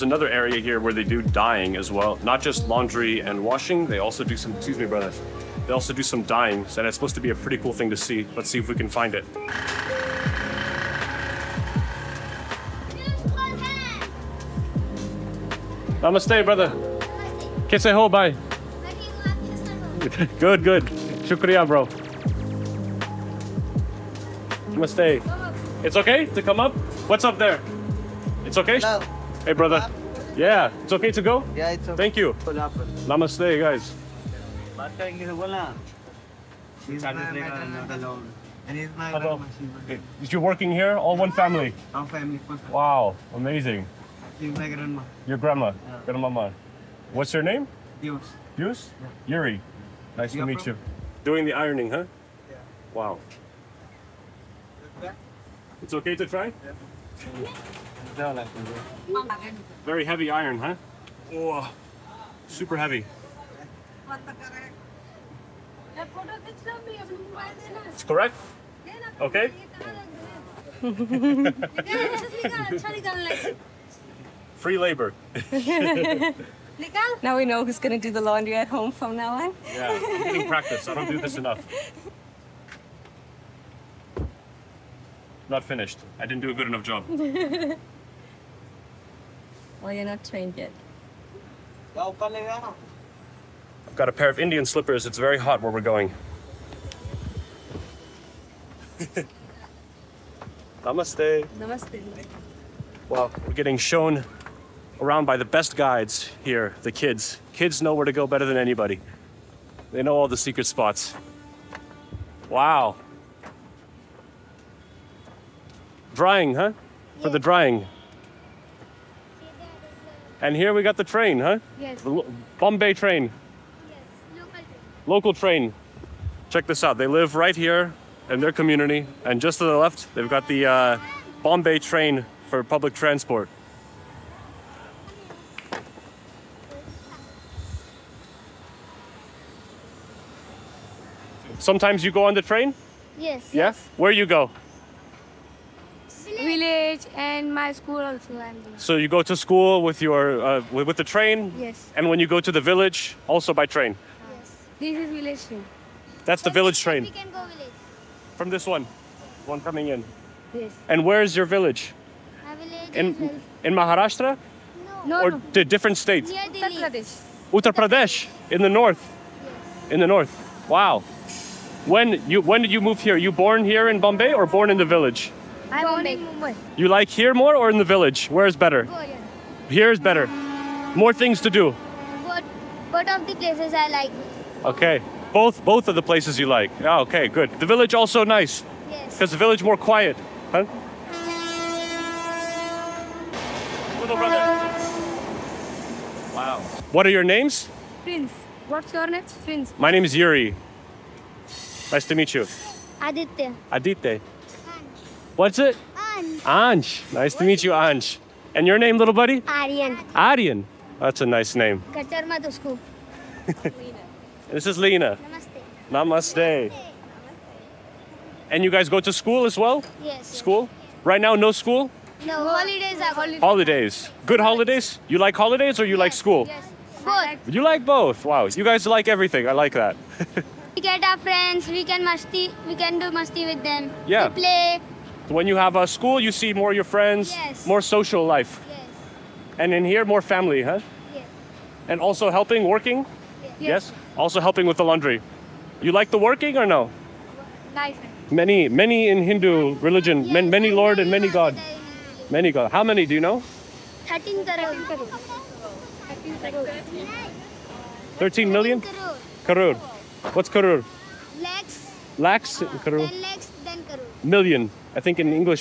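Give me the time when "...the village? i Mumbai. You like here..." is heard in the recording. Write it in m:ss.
2:54.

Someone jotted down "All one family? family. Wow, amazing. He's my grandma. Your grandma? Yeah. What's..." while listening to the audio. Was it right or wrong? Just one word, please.
right.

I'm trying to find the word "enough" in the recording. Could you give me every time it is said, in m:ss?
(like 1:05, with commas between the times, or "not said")
1:21, 1:26.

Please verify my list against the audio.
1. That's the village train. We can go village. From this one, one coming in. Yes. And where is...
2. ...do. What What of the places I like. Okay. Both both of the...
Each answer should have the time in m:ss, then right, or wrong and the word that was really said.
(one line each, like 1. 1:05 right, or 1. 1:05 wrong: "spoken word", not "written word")
1. 2:36 right
2. 3:01 right.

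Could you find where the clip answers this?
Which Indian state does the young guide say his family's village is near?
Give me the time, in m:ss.
2:46.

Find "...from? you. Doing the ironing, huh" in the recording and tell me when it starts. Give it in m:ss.
0:50.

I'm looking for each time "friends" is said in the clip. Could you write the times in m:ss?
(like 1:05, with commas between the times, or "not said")
3:51, 3:56.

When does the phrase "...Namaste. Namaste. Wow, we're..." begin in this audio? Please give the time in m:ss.
1:40.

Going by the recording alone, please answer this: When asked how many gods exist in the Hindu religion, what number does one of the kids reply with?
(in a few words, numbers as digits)
13 crore.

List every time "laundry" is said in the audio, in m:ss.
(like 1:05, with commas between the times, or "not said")
0:02, 1:18, 4:04.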